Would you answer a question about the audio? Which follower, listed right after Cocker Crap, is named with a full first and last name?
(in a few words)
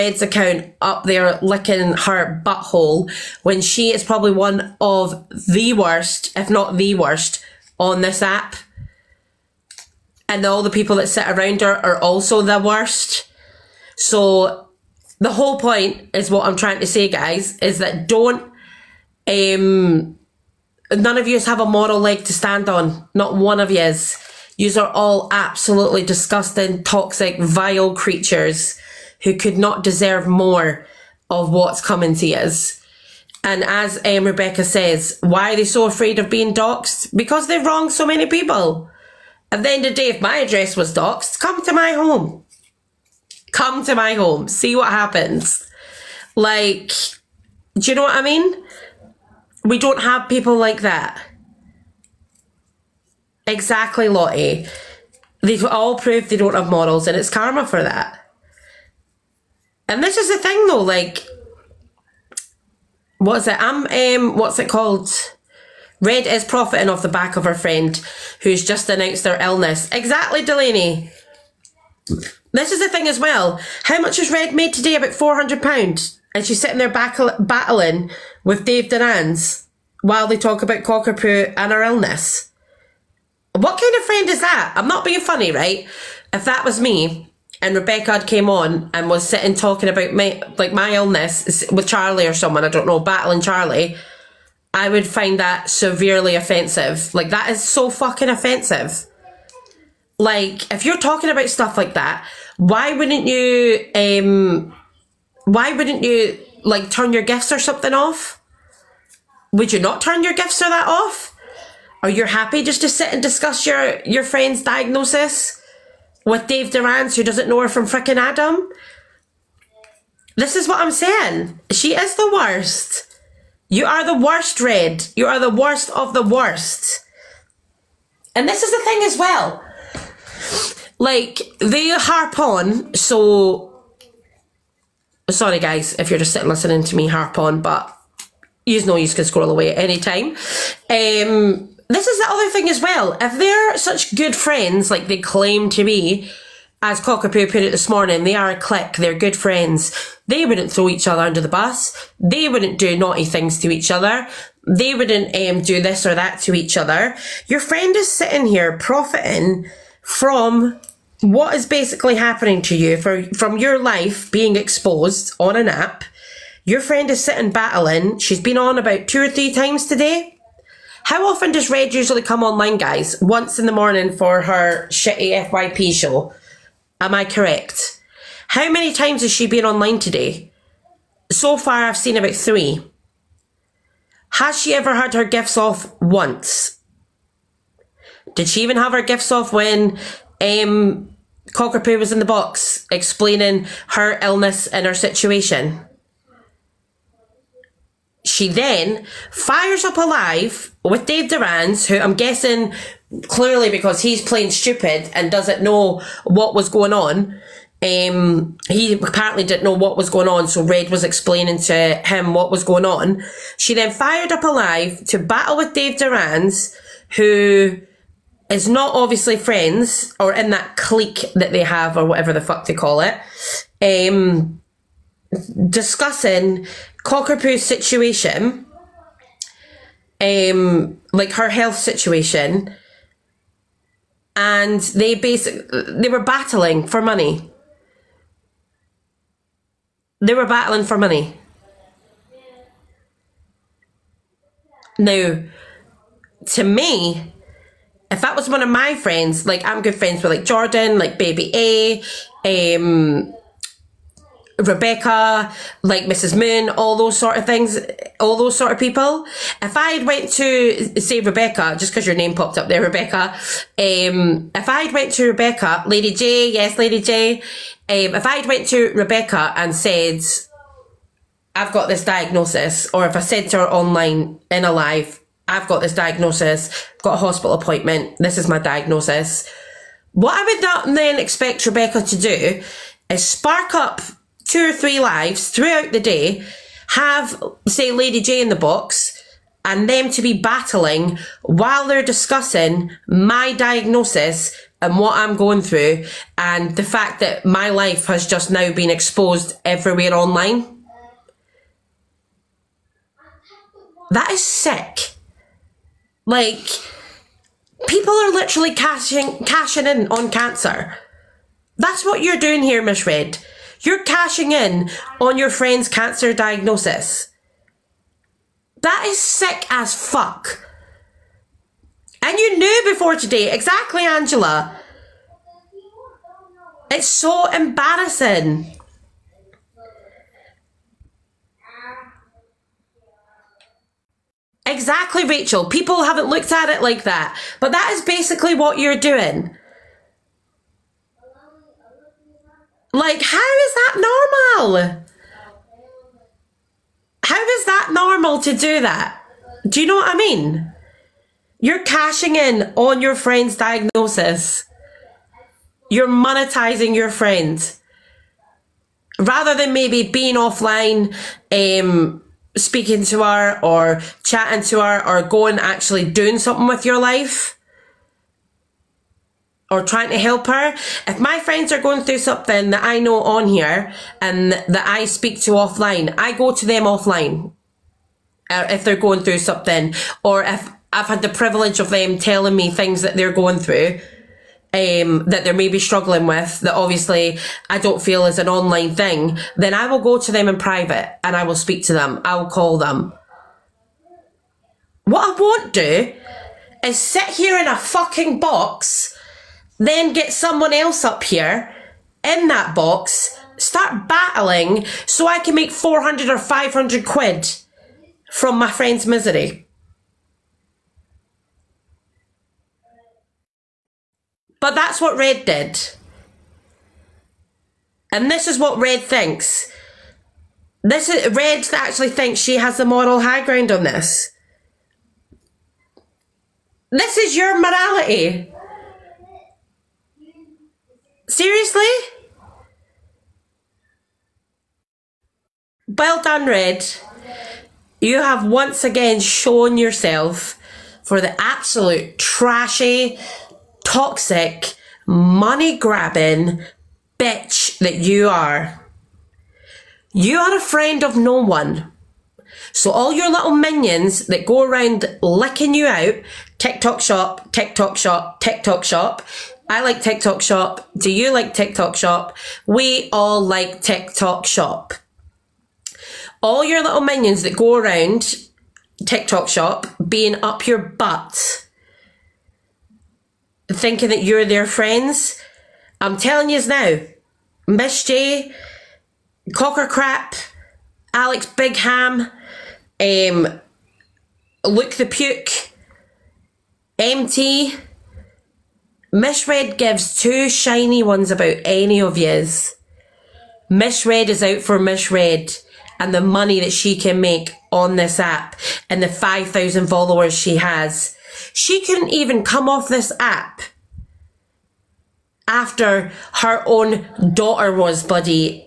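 Alex Bigham.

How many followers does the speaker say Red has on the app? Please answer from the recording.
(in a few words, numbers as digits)
5,000.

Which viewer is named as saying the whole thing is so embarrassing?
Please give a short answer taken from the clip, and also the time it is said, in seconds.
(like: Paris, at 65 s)
Angela, at 324 s.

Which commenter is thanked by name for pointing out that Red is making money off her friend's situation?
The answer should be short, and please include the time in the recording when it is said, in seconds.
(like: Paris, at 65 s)
Delaney, at 70 s.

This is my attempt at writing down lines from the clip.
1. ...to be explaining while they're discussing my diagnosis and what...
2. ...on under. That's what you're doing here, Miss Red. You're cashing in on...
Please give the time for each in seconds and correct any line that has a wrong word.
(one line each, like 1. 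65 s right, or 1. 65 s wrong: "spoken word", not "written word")
1. 290 s wrong: "battling", not "explaining"
2. 310 s wrong: "cancer", not "under".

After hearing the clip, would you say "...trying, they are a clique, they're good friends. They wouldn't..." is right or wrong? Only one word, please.
wrong.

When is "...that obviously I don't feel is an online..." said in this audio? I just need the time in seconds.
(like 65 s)
386 s.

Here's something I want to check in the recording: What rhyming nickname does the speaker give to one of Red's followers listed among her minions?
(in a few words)
Luke the Puke.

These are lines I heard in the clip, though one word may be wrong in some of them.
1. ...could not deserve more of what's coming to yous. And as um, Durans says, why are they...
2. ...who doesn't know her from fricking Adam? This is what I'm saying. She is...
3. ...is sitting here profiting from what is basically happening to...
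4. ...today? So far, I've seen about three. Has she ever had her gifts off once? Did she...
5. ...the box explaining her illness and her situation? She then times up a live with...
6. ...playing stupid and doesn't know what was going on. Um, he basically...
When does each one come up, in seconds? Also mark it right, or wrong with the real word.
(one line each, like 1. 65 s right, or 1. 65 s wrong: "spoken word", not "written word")
1. 29 s wrong: "Rebecca", not "Durans"
2. 117 s right
3. 157 s right
4. 179 s right
5. 192 s wrong: "fires", not "times"
6. 204 s wrong: "apparently", not "basically".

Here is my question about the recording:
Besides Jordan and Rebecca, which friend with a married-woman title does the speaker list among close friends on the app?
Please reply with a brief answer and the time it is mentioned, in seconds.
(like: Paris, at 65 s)
Mrs. Moon, at 256 s.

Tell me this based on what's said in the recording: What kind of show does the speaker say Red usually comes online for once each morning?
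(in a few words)
FYP show.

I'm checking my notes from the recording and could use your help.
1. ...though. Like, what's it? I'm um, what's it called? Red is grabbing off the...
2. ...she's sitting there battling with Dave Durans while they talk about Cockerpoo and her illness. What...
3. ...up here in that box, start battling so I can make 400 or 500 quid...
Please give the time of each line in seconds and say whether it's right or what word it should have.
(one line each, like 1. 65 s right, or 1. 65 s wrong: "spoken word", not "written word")
1. 60 s wrong: "profiting", not "grabbing"
2. 76 s right
3. 401 s right.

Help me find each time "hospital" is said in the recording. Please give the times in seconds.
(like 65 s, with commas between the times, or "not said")
277 s.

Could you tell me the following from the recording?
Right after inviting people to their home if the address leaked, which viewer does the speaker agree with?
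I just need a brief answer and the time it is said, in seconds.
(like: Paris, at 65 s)
Lottie, at 54 s.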